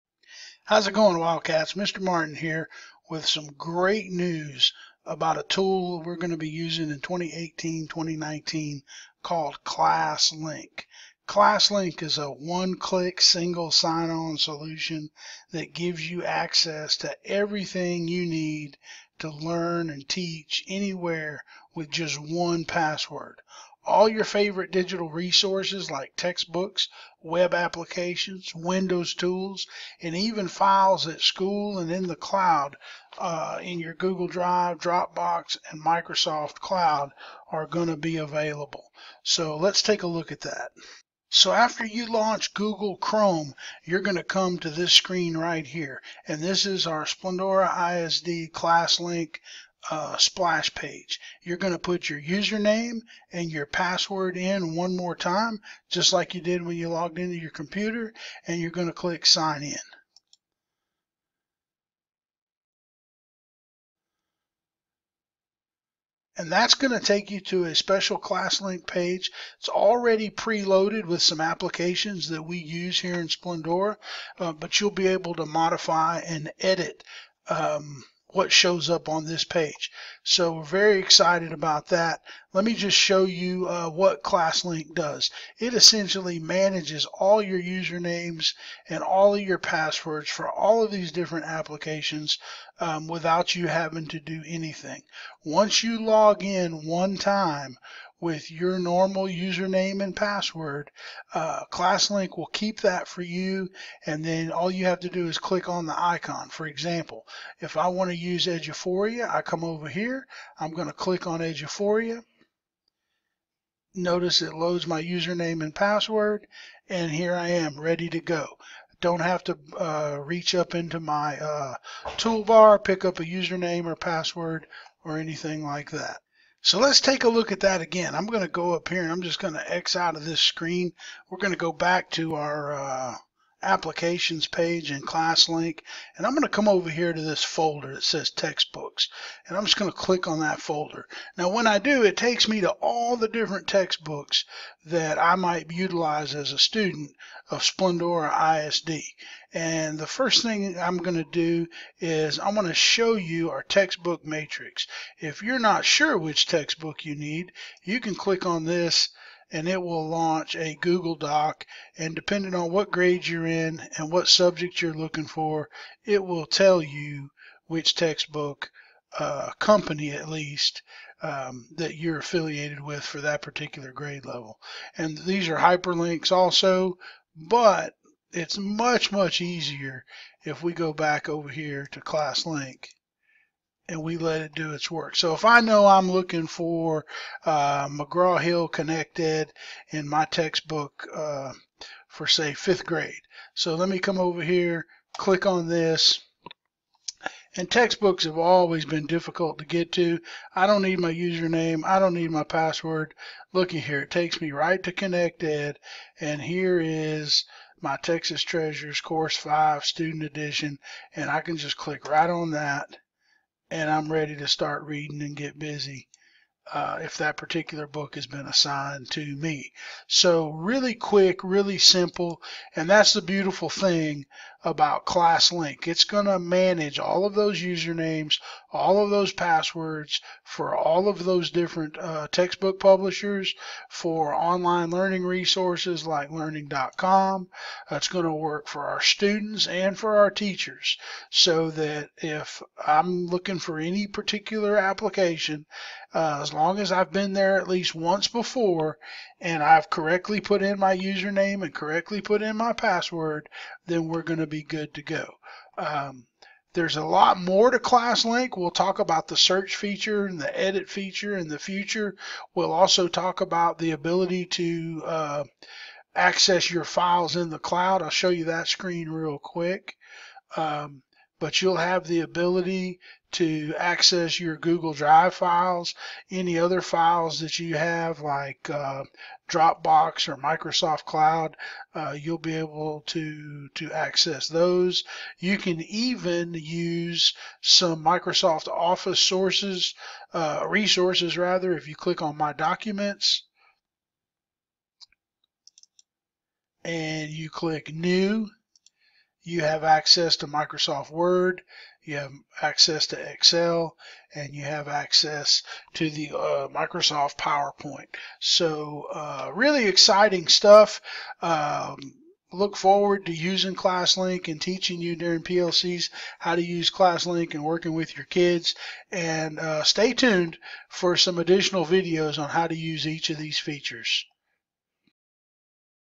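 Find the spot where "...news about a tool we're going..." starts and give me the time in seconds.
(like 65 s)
4 s.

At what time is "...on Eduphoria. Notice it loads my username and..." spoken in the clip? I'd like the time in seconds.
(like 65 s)
111 s.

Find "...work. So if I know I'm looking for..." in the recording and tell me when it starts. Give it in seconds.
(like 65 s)
184 s.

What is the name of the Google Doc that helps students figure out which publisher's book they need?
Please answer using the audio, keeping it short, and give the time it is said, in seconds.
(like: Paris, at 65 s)
textbook matrix, at 153 s.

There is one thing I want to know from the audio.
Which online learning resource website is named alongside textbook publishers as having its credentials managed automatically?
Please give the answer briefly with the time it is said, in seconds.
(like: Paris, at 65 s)
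learning.com, at 236 s.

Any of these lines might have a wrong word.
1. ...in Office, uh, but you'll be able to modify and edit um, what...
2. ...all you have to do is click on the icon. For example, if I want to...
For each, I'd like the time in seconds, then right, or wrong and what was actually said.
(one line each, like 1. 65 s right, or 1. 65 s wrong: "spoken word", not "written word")
1. 73 s wrong: "Splendora", not "Office"
2. 104 s right.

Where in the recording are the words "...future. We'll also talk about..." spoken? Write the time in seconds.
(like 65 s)
261 s.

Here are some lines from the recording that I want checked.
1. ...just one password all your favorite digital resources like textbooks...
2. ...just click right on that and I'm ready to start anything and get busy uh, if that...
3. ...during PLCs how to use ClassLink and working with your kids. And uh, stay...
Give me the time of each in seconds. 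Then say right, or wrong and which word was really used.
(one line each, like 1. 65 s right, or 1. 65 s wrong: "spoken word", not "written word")
1. 21 s right
2. 211 s wrong: "reading", not "anything"
3. 315 s right.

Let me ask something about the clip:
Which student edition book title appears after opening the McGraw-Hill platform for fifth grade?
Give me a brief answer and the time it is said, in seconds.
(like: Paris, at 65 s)
Texas Treasures Course 5, at 207 s.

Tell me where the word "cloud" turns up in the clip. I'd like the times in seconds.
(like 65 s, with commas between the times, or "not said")
32 s, 36 s, 267 s, 281 s.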